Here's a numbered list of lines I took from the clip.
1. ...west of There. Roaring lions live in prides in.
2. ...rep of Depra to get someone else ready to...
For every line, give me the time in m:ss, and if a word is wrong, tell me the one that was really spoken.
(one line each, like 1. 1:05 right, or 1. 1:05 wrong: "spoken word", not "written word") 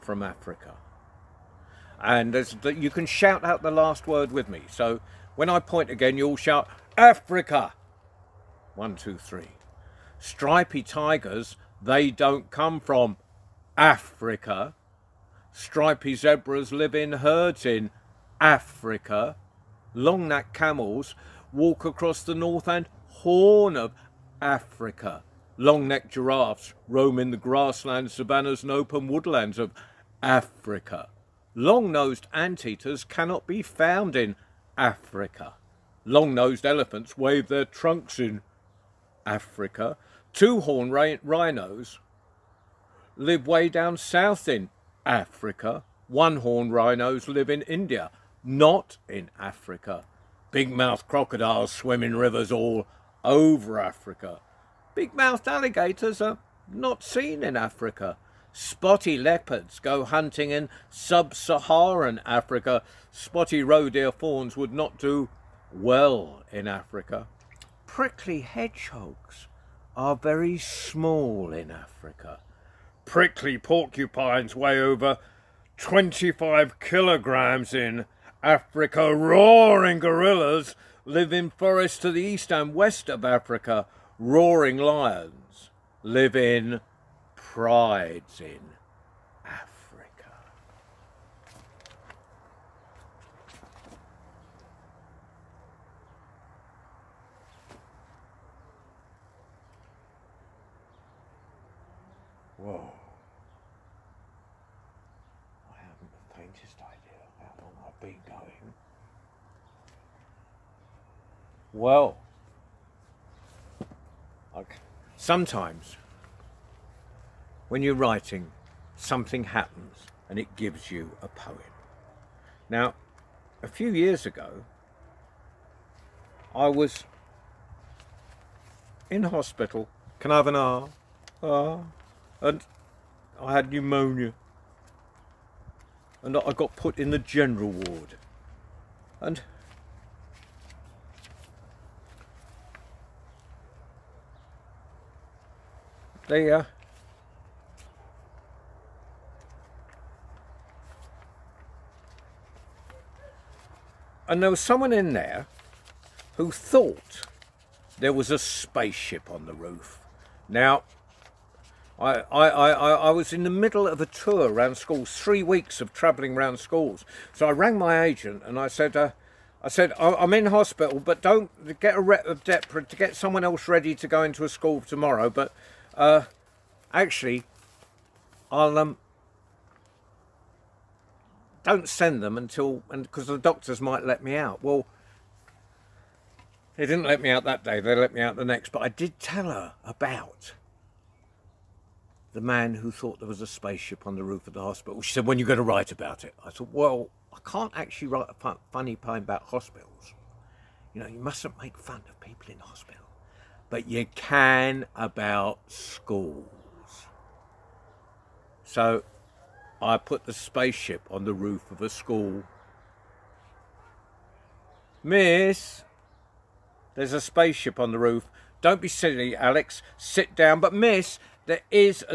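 1. 1:22 wrong: "Africa", not "There"
2. 2:51 right.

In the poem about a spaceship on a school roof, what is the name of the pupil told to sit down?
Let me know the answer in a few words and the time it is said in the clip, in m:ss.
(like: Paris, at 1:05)
Alex, at 3:39.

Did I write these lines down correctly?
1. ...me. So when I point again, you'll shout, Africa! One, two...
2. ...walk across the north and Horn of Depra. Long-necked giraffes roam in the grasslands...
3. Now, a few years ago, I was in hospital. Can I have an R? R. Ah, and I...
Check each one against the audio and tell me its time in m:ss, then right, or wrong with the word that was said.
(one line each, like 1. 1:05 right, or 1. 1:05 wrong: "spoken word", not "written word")
1. 0:04 right
2. 0:21 wrong: "Africa", not "Depra"
3. 2:02 right.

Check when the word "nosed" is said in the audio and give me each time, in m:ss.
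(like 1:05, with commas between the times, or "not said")
0:31, 0:36.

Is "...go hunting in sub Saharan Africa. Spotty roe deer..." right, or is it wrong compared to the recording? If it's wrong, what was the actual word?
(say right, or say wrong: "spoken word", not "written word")
right.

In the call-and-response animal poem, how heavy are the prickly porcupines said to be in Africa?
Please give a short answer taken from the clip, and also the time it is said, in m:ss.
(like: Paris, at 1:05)
over 25 kilograms, at 1:14.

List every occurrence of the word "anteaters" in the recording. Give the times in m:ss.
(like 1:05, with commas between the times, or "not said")
0:32.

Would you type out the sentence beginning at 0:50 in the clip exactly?
Big-mouthed crocodiles swim in rivers all over Africa.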